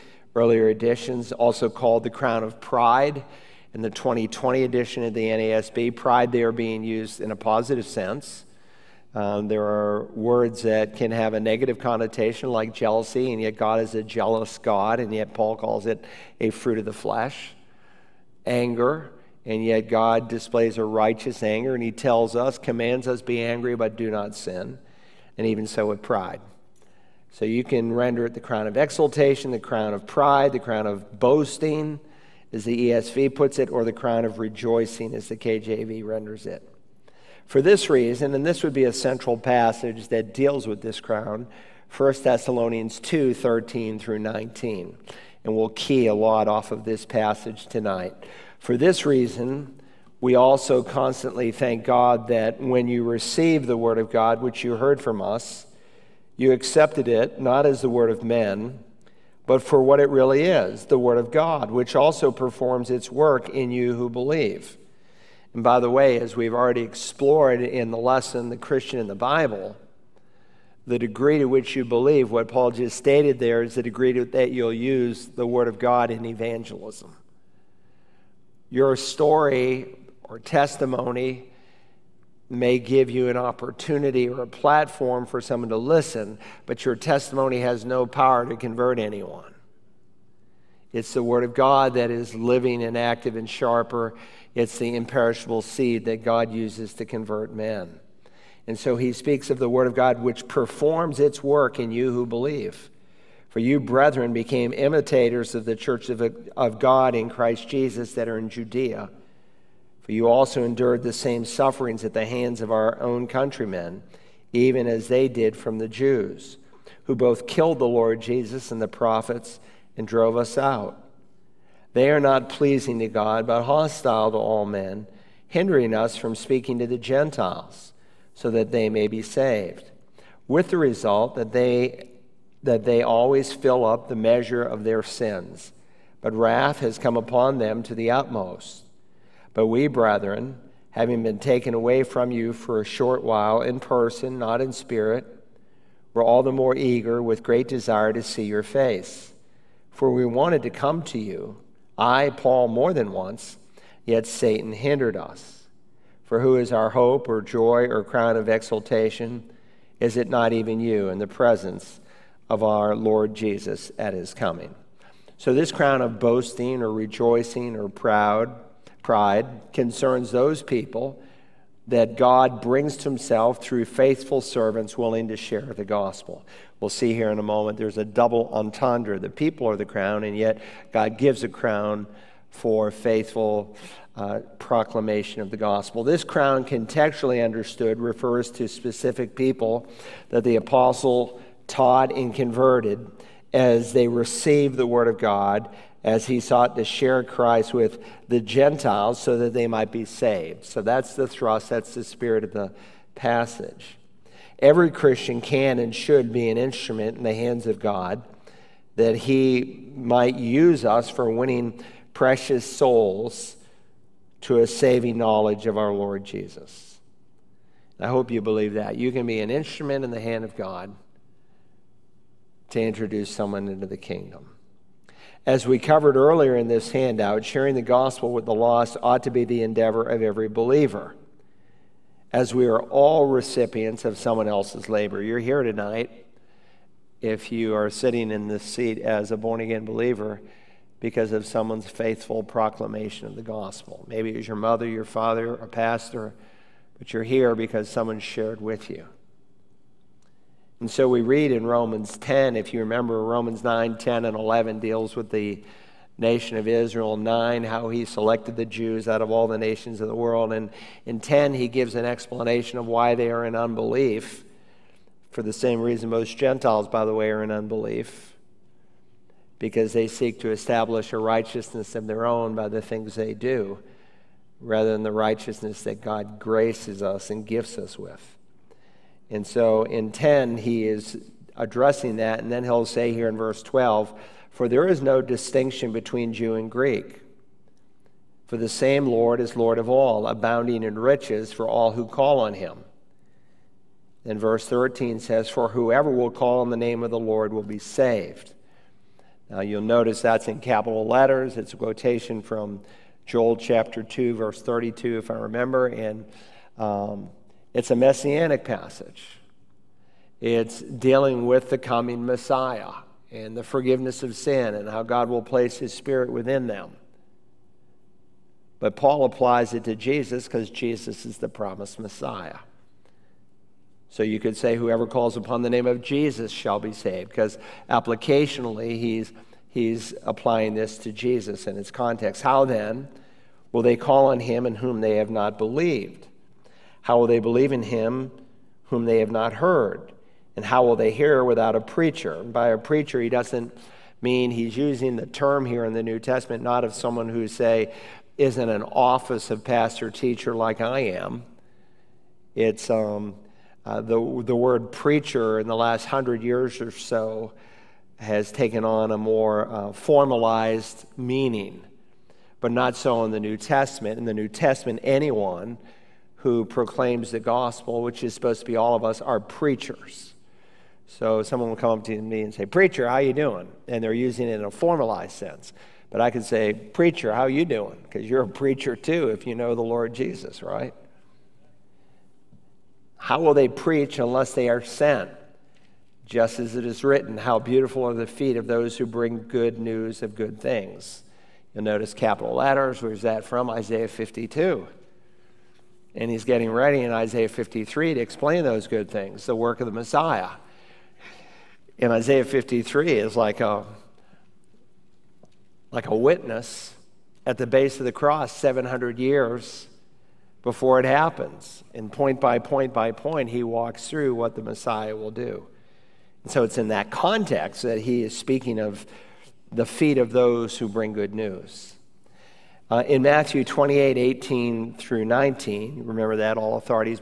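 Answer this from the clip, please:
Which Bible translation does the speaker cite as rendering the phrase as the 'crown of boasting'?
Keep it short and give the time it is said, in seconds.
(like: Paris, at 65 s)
ESV, at 32 s.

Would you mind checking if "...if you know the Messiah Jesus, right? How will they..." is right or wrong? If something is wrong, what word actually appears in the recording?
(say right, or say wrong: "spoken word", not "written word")
wrong: "Lord", not "Messiah".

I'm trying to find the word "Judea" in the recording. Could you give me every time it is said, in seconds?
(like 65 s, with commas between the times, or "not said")
108 s.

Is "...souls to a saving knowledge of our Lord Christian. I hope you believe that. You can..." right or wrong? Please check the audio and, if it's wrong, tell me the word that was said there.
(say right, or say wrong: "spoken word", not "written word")
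wrong: "Jesus", not "Christian".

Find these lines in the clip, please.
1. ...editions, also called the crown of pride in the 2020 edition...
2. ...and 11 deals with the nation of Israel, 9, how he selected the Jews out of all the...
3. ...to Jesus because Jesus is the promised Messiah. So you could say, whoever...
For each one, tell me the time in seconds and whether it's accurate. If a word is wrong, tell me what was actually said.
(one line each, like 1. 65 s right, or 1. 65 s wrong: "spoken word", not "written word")
1. 0 s right
2. 254 s right
3. 319 s right.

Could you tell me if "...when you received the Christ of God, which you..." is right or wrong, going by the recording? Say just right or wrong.
wrong.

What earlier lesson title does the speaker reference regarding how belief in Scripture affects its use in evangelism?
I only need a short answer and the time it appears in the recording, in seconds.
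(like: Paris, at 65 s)
The Christian in the Bible, at 68 s.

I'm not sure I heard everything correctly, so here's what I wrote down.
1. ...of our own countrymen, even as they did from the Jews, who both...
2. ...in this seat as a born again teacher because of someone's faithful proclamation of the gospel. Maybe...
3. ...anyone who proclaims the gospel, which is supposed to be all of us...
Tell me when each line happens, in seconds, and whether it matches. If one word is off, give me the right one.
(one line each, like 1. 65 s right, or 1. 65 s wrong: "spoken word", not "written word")
1. 112 s right
2. 238 s wrong: "believer", not "teacher"
3. 365 s right.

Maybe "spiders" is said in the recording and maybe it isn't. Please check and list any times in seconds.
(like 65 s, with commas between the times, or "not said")
not said.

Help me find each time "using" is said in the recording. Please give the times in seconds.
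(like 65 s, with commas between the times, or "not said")
344 s, 374 s.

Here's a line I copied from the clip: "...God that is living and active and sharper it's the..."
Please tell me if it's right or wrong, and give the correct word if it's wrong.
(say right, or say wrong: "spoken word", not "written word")
right.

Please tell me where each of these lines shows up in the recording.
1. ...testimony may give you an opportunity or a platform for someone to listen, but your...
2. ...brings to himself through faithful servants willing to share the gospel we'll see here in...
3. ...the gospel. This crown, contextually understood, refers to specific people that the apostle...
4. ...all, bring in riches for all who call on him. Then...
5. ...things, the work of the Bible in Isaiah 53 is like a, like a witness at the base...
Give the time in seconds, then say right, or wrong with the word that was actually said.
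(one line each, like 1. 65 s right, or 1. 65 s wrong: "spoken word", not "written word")
1. 80 s right
2. 172 s right
3. 185 s right
4. 289 s wrong: "abounding", not "bring"
5. 399 s wrong: "Messiah", not "Bible".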